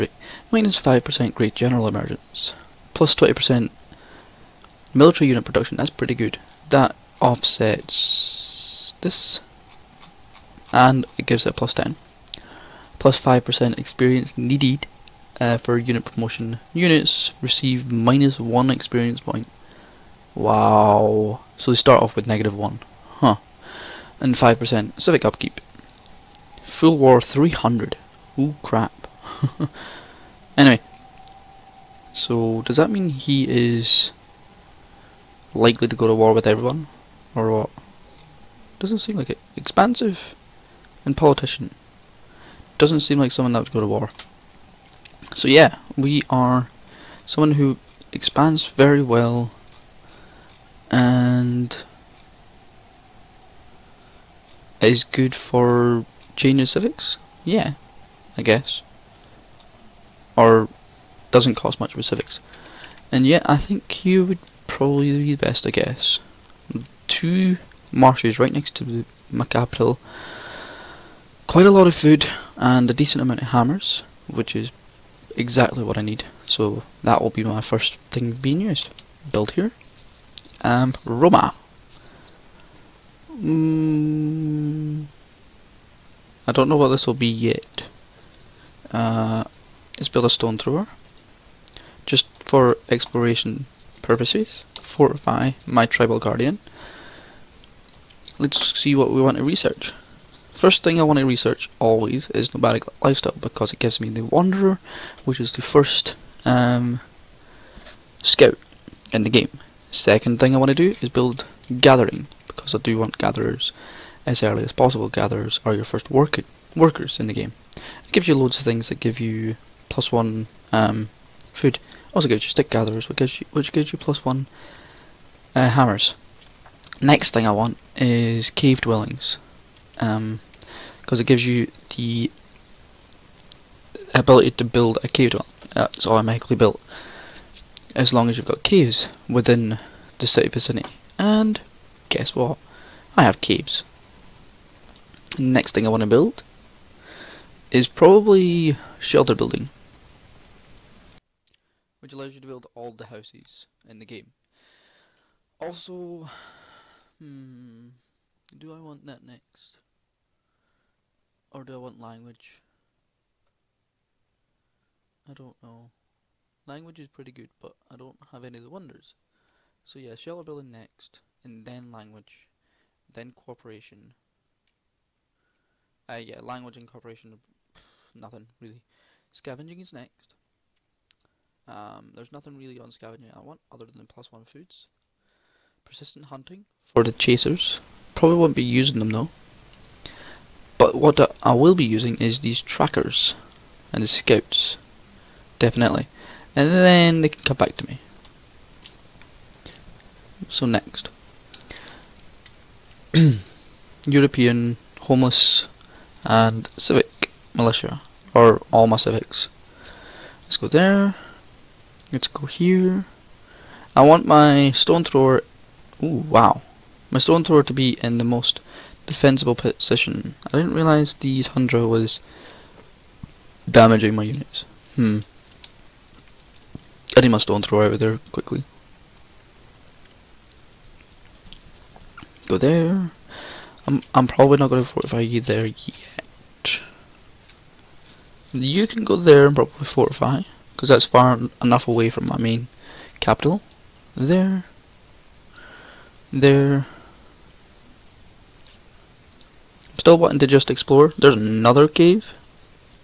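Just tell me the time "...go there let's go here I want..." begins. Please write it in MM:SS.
03:30.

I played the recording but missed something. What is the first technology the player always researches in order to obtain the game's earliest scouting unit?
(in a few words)
Nomadic lifestyle.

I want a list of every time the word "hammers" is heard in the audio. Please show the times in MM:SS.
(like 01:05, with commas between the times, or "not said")
01:13, 02:05.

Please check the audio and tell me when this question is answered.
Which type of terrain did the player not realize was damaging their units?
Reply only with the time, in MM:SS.
03:41.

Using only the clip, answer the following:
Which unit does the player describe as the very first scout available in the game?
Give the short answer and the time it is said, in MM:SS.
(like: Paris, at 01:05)
The wanderer, at 01:44.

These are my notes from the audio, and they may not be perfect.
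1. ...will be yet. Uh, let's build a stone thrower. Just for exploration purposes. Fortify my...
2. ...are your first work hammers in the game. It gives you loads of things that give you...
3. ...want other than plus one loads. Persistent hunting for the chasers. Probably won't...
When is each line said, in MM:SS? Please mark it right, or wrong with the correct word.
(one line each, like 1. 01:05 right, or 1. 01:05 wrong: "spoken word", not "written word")
1. 01:27 right
2. 01:55 wrong: "workers", not "hammers"
3. 03:03 wrong: "foods", not "loads".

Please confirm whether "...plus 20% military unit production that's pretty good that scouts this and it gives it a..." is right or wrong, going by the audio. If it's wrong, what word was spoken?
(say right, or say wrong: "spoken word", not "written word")
wrong: "offsets", not "scouts".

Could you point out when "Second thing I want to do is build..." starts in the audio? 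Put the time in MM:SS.
01:49.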